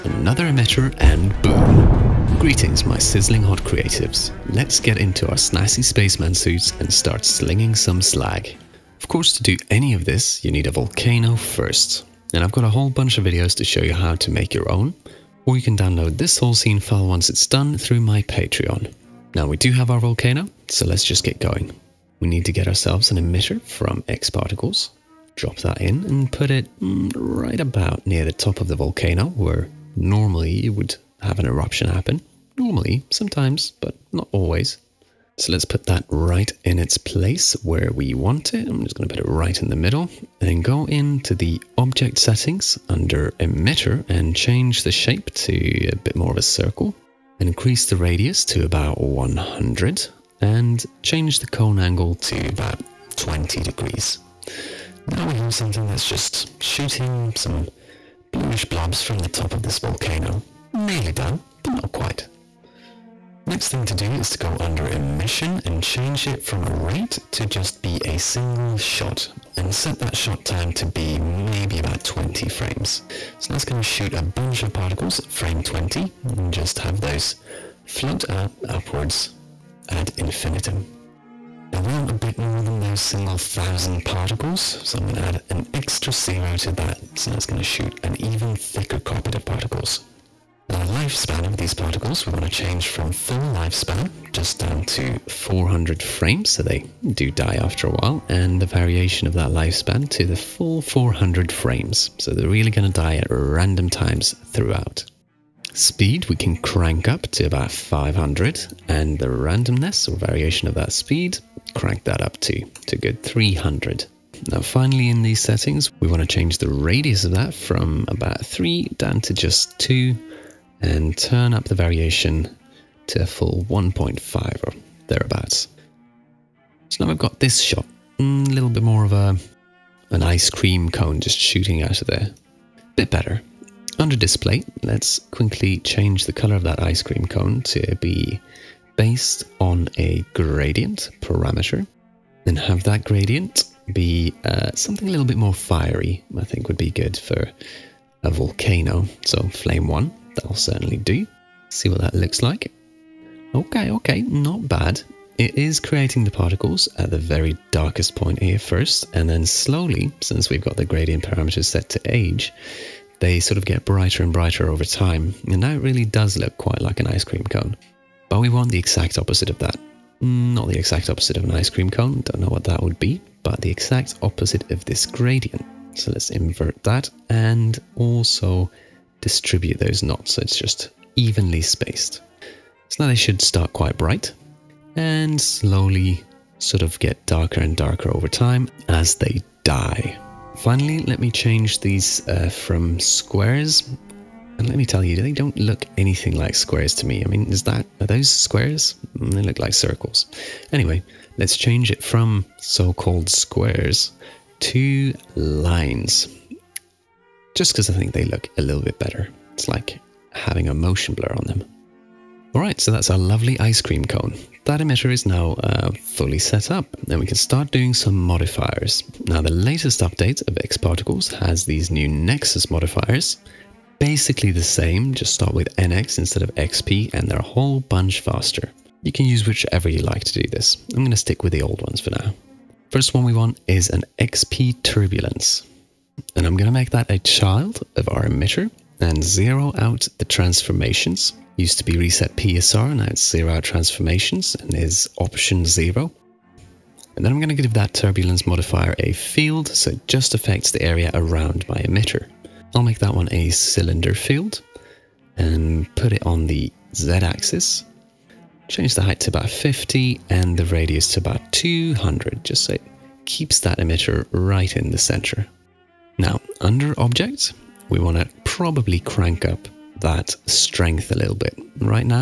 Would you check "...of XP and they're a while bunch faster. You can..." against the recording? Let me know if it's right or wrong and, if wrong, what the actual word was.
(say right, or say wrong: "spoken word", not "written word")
wrong: "whole", not "while".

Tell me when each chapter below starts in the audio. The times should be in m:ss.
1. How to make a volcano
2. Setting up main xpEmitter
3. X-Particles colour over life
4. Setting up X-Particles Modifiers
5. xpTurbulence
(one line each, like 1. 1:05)
1. 0:09
2. 0:21
3. 2:13
4. 3:37
5. 3:53.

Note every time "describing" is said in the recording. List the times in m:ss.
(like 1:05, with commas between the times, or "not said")
not said.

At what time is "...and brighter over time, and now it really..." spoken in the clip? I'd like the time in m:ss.
2:44.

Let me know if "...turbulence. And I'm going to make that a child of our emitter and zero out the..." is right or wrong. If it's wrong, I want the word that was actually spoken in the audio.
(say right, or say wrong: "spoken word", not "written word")
right.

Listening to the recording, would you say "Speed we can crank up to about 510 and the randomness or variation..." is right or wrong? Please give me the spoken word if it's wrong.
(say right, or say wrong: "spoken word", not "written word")
wrong: "500", not "510".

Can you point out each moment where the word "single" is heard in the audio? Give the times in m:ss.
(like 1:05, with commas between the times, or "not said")
1:08, 1:23.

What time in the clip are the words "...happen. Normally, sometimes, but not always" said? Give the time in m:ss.
0:31.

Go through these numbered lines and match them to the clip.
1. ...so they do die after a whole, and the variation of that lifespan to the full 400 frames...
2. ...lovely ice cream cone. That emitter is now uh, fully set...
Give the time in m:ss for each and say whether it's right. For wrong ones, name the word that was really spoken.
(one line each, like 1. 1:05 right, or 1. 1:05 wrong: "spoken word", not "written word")
1. 1:36 wrong: "while", not "whole"
2. 3:33 right.